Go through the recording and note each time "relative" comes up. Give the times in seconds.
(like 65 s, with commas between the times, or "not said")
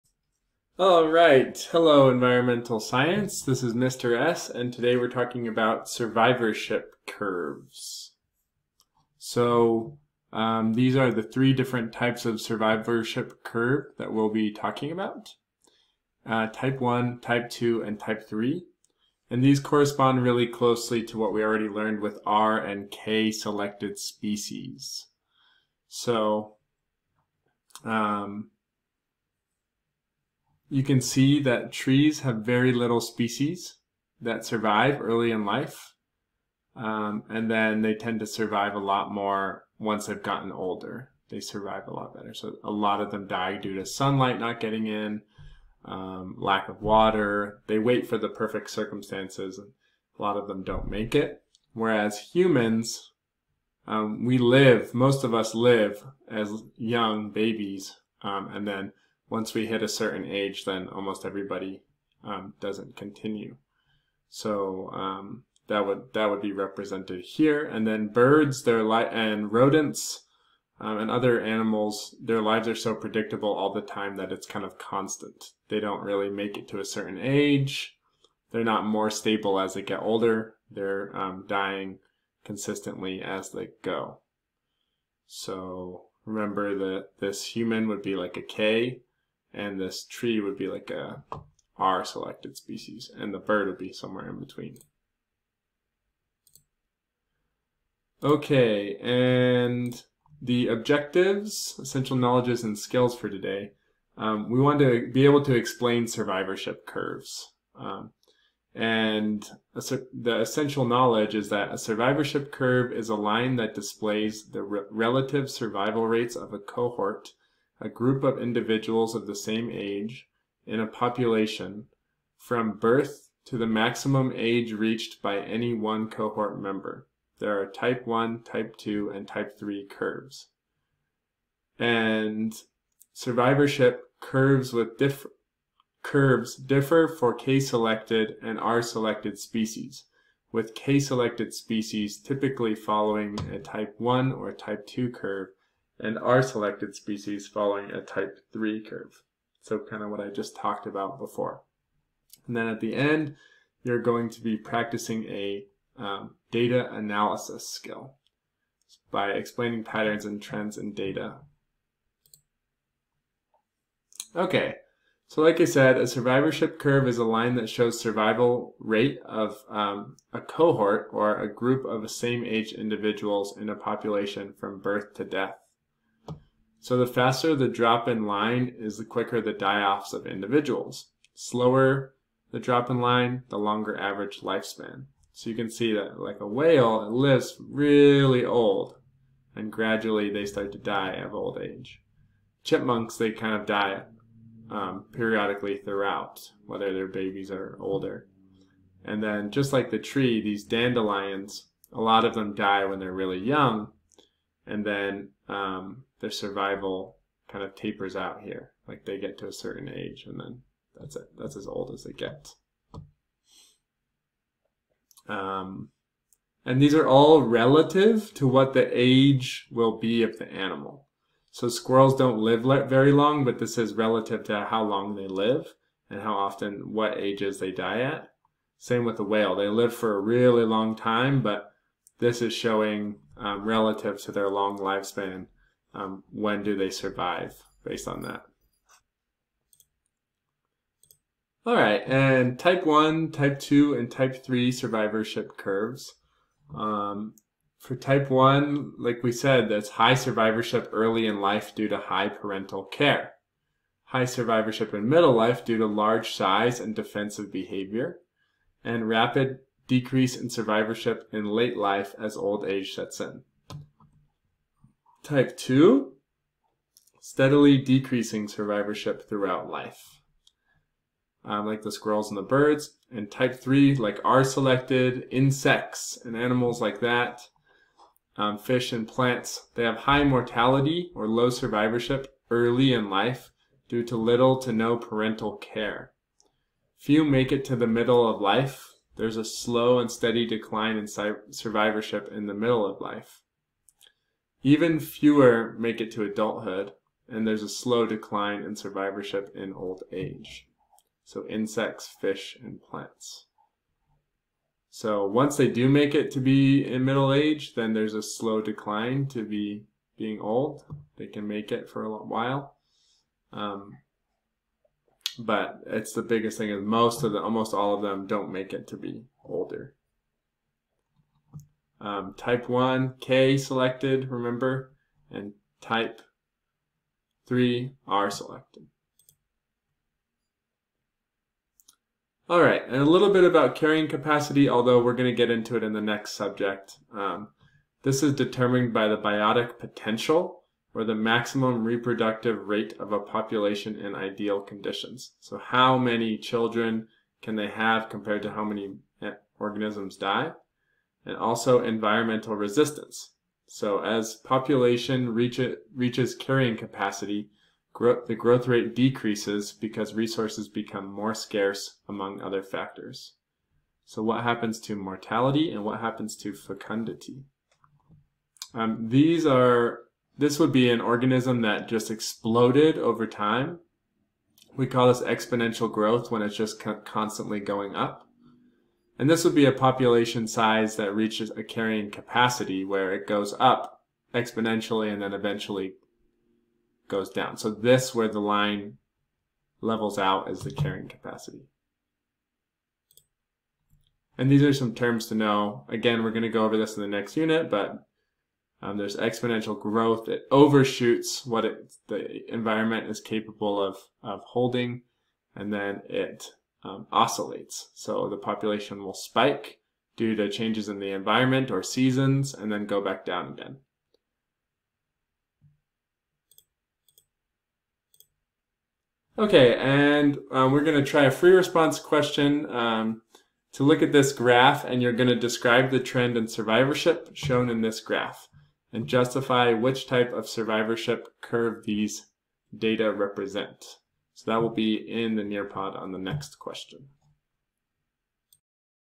114 s, 217 s, 223 s, 233 s.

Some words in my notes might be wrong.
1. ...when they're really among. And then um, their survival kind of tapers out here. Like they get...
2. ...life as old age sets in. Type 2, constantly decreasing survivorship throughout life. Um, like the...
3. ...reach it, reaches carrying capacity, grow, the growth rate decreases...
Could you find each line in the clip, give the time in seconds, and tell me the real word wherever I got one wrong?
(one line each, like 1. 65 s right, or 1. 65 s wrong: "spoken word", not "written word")
1. 202 s wrong: "young", not "among"
2. 261 s wrong: "steadily", not "constantly"
3. 355 s right.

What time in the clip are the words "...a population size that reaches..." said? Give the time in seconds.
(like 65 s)
379 s.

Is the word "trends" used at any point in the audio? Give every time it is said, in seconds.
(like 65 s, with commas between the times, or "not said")
160 s, 425 s.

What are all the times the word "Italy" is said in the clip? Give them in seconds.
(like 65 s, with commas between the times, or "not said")
not said.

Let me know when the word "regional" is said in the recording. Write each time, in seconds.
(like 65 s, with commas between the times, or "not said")
not said.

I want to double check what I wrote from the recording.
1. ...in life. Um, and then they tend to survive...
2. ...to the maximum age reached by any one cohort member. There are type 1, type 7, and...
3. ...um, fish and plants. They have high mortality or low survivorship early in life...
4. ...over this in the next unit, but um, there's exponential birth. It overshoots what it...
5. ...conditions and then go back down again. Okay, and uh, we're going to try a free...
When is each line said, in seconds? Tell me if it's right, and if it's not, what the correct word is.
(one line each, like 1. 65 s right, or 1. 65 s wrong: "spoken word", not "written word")
1. 35 s right
2. 123 s wrong: "2", not "7"
3. 278 s right
4. 396 s wrong: "growth", not "birth"
5. 411 s wrong: "seasons", not "conditions".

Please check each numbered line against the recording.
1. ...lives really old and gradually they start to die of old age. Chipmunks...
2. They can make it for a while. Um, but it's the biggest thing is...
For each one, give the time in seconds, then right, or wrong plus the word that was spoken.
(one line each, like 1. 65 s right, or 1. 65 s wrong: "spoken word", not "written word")
1. 187 s right
2. 311 s right.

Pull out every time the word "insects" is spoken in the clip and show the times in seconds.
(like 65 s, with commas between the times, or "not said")
275 s, 301 s.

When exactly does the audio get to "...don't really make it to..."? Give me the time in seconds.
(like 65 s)
75 s.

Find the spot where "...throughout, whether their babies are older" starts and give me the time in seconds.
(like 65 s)
195 s.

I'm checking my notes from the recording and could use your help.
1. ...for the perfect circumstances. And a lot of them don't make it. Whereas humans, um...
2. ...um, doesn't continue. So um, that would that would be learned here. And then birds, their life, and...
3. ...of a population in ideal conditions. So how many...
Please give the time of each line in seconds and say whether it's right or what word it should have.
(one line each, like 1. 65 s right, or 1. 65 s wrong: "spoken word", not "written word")
1. 48 s right
2. 62 s wrong: "represented", not "learned"
3. 342 s right.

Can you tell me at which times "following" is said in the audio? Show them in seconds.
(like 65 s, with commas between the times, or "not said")
142 s, 147 s.